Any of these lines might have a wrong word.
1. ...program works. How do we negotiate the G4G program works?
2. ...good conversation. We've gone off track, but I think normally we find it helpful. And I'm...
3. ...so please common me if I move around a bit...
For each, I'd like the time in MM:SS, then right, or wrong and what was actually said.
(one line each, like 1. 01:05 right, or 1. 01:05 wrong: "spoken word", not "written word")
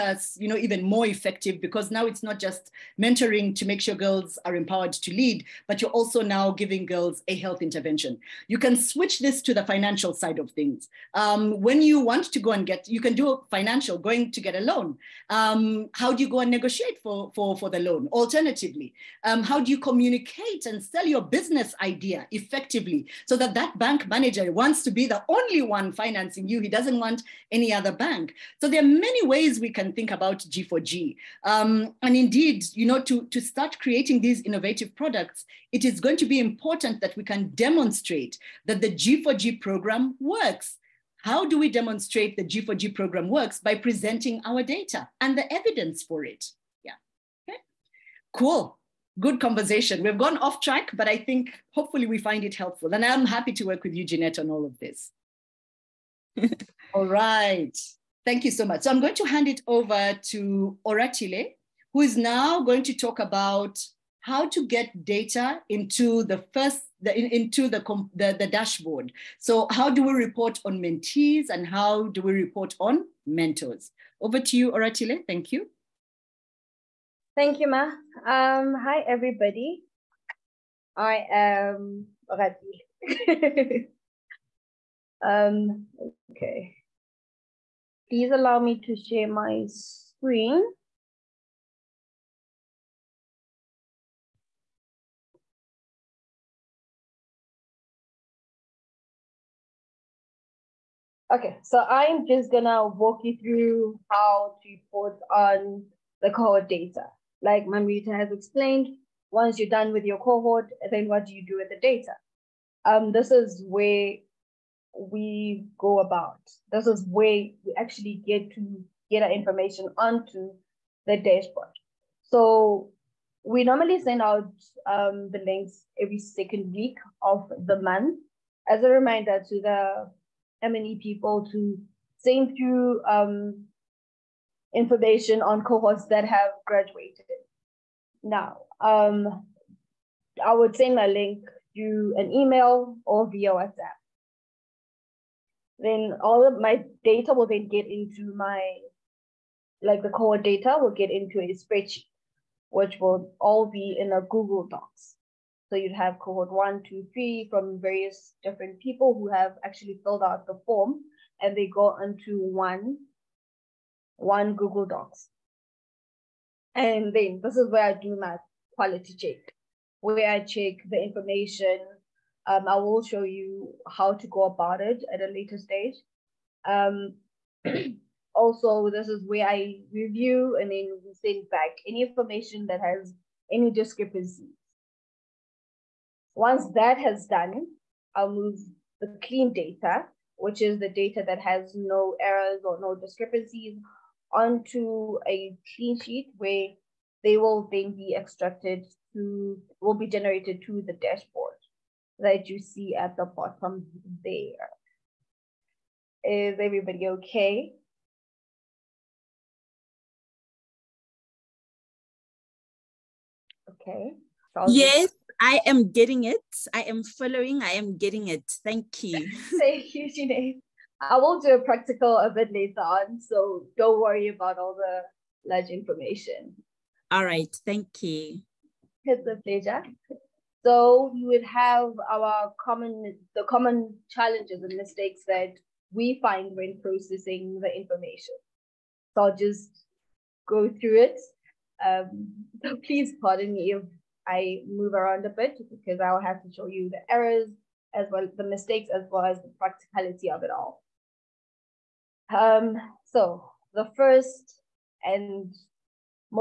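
1. 00:39 wrong: "demonstrate", not "negotiate"
2. 00:49 wrong: "hopefully", not "normally"
3. 04:02 wrong: "pardon", not "common".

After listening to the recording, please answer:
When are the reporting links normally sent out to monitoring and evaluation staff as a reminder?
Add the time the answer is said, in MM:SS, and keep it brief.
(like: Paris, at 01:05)
every second week of the month, at 02:06.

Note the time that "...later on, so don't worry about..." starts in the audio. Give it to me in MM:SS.
03:42.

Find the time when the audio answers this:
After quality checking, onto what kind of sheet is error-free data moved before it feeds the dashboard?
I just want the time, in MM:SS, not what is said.
03:15.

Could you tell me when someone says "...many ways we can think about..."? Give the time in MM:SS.
00:28.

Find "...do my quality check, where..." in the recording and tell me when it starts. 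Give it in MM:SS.
02:47.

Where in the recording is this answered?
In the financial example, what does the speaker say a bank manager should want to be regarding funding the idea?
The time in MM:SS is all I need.
00:25.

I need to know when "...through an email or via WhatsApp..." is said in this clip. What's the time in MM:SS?
02:21.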